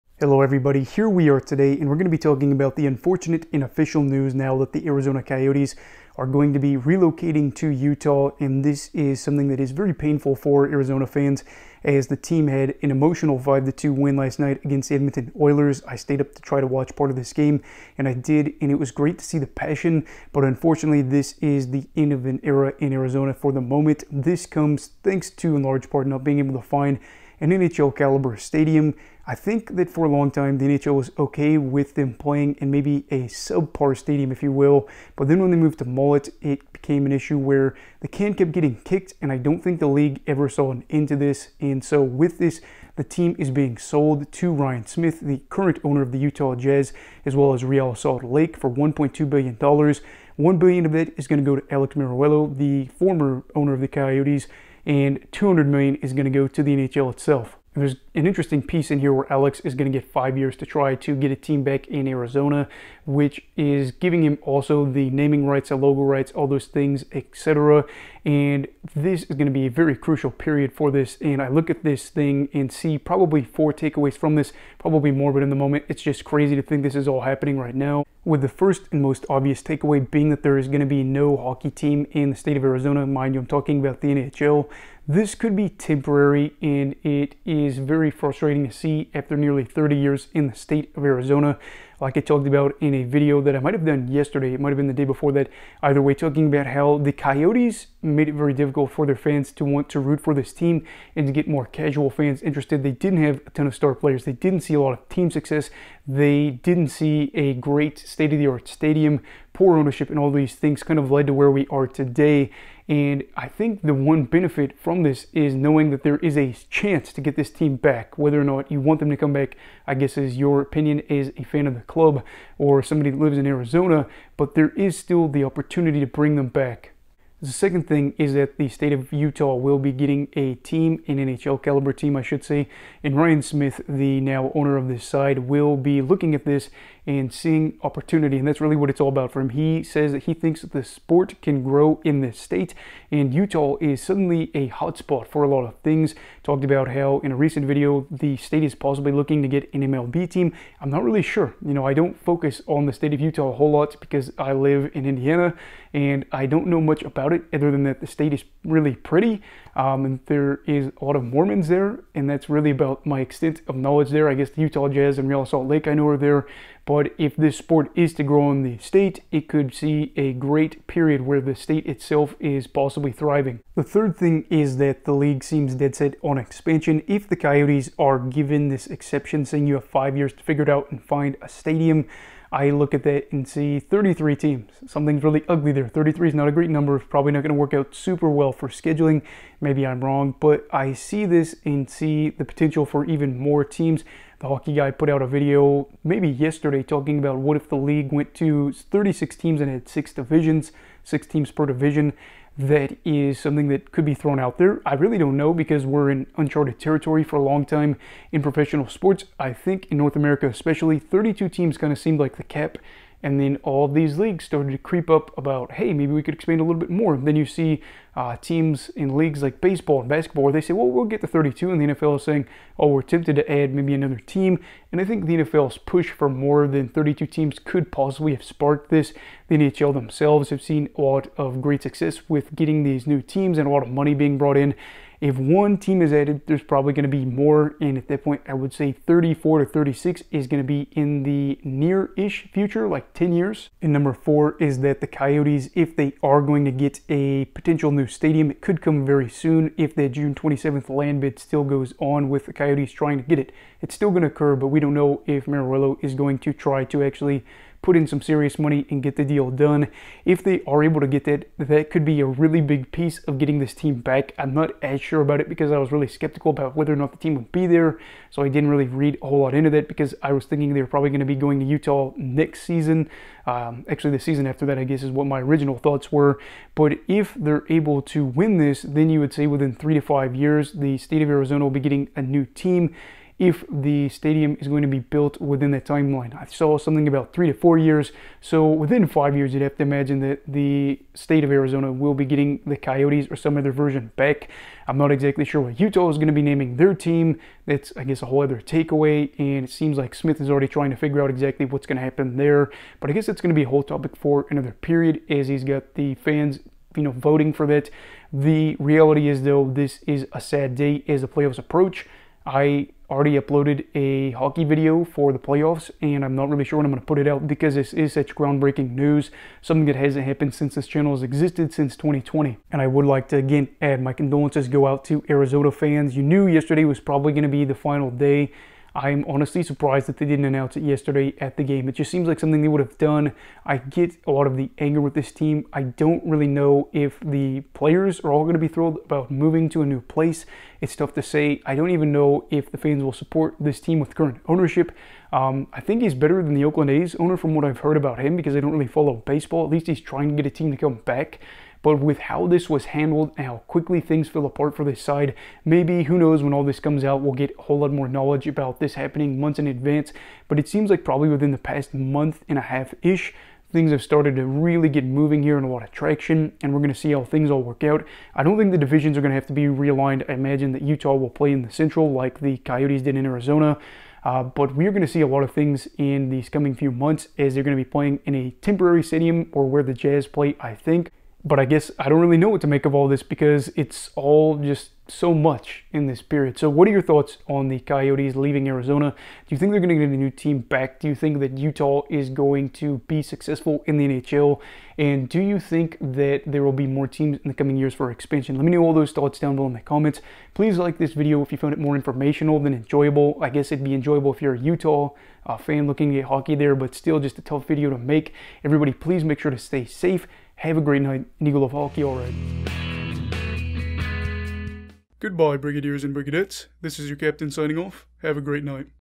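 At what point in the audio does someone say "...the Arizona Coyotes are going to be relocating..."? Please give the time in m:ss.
0:04.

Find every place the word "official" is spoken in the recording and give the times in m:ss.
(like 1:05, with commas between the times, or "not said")
0:03.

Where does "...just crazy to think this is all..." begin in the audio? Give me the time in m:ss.
1:16.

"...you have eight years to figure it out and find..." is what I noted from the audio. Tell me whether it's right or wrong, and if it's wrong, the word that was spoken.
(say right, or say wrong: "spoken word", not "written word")
wrong: "five", not "eight".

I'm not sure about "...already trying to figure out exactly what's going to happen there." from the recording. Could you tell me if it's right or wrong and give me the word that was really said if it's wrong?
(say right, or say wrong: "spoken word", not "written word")
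right.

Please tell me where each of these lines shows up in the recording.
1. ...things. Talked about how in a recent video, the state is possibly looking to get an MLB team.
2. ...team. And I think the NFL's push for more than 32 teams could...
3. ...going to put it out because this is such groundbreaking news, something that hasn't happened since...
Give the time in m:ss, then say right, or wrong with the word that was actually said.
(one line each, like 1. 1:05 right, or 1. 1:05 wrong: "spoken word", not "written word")
1. 2:25 right
2. 3:44 right
3. 5:16 right.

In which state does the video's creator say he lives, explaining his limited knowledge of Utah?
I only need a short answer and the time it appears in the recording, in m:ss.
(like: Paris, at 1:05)
Indiana, at 2:35.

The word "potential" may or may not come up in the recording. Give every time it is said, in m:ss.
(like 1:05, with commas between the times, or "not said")
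3:12, 4:07.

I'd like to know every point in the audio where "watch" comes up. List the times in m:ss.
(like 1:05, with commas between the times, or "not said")
0:16.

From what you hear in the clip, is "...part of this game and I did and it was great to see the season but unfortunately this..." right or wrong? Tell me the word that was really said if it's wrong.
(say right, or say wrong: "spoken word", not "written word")
wrong: "passion", not "season".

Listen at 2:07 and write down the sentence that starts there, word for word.
The second thing is that the state of Utah will be getting a team, an NHL caliber team, I should say.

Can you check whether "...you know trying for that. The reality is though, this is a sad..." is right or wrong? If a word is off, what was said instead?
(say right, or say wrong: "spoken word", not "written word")
wrong: "voting", not "trying".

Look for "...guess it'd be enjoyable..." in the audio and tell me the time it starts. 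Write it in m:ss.
6:43.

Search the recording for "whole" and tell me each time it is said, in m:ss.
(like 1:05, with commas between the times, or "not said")
2:33, 4:29, 4:58, 5:03, 5:57.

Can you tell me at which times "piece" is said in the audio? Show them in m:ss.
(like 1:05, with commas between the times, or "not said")
0:58, 4:22.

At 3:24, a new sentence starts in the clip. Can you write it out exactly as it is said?
I really don't know because we're in uncharted territory for a long time in professional sports.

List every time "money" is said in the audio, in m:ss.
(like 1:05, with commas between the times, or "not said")
3:53, 4:18.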